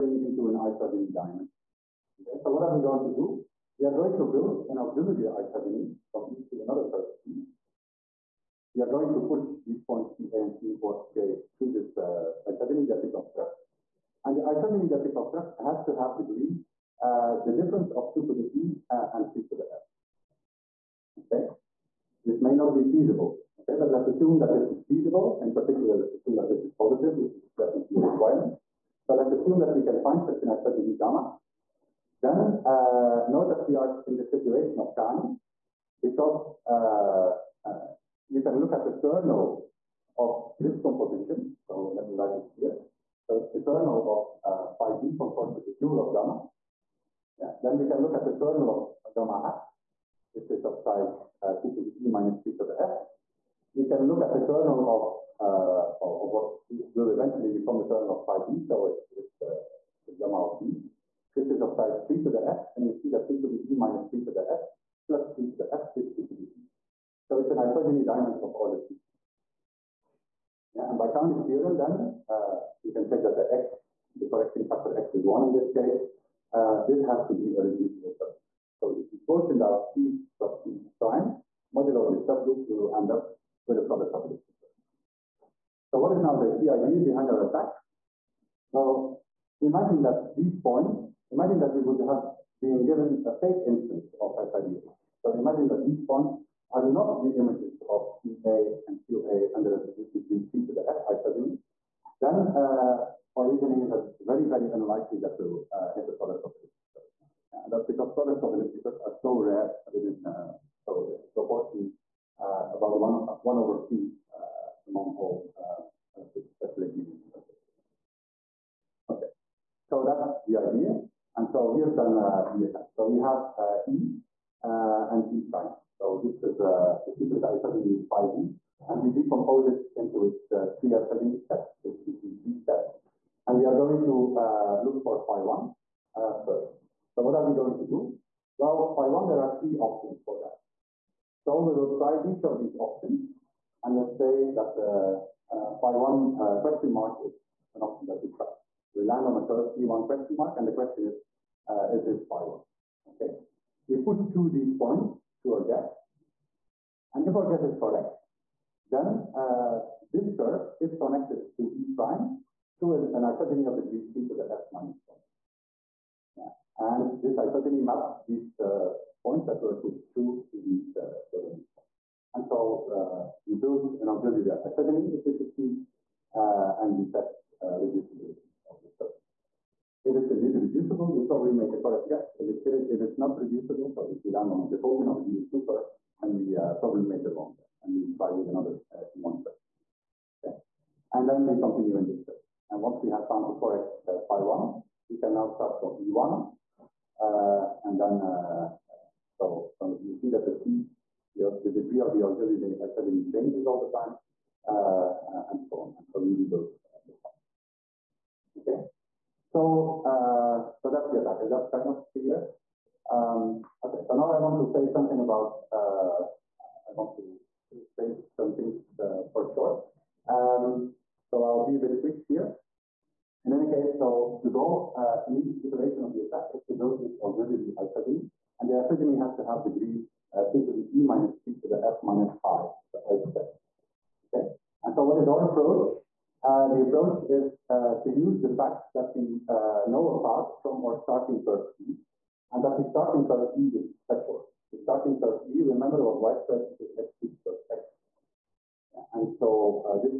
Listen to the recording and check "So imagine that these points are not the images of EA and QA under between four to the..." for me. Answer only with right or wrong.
wrong.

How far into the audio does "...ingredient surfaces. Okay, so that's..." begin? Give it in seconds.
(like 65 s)
116 s.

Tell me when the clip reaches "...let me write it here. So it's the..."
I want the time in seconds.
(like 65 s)
41 s.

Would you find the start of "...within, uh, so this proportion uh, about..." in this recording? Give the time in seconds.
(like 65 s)
109 s.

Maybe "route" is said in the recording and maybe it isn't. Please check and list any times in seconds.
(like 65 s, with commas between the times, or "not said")
not said.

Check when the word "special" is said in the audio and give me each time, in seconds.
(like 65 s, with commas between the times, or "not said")
116 s, 244 s.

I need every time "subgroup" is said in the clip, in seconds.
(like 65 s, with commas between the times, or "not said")
78 s, 82 s.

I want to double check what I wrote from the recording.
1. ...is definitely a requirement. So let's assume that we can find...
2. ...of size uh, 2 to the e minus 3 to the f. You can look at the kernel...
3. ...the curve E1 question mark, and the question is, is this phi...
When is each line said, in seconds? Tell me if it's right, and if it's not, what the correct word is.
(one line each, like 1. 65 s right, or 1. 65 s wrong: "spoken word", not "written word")
1. 27 s right
2. 50 s right
3. 149 s right.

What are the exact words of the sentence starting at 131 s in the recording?
It's it be three steps, and we are going to uh, look for phi one uh, first.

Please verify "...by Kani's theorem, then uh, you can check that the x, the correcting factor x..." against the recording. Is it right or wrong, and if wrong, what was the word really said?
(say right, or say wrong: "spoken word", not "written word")
right.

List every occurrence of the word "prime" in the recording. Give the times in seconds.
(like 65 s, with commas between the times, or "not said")
80 s, 125 s, 161 s.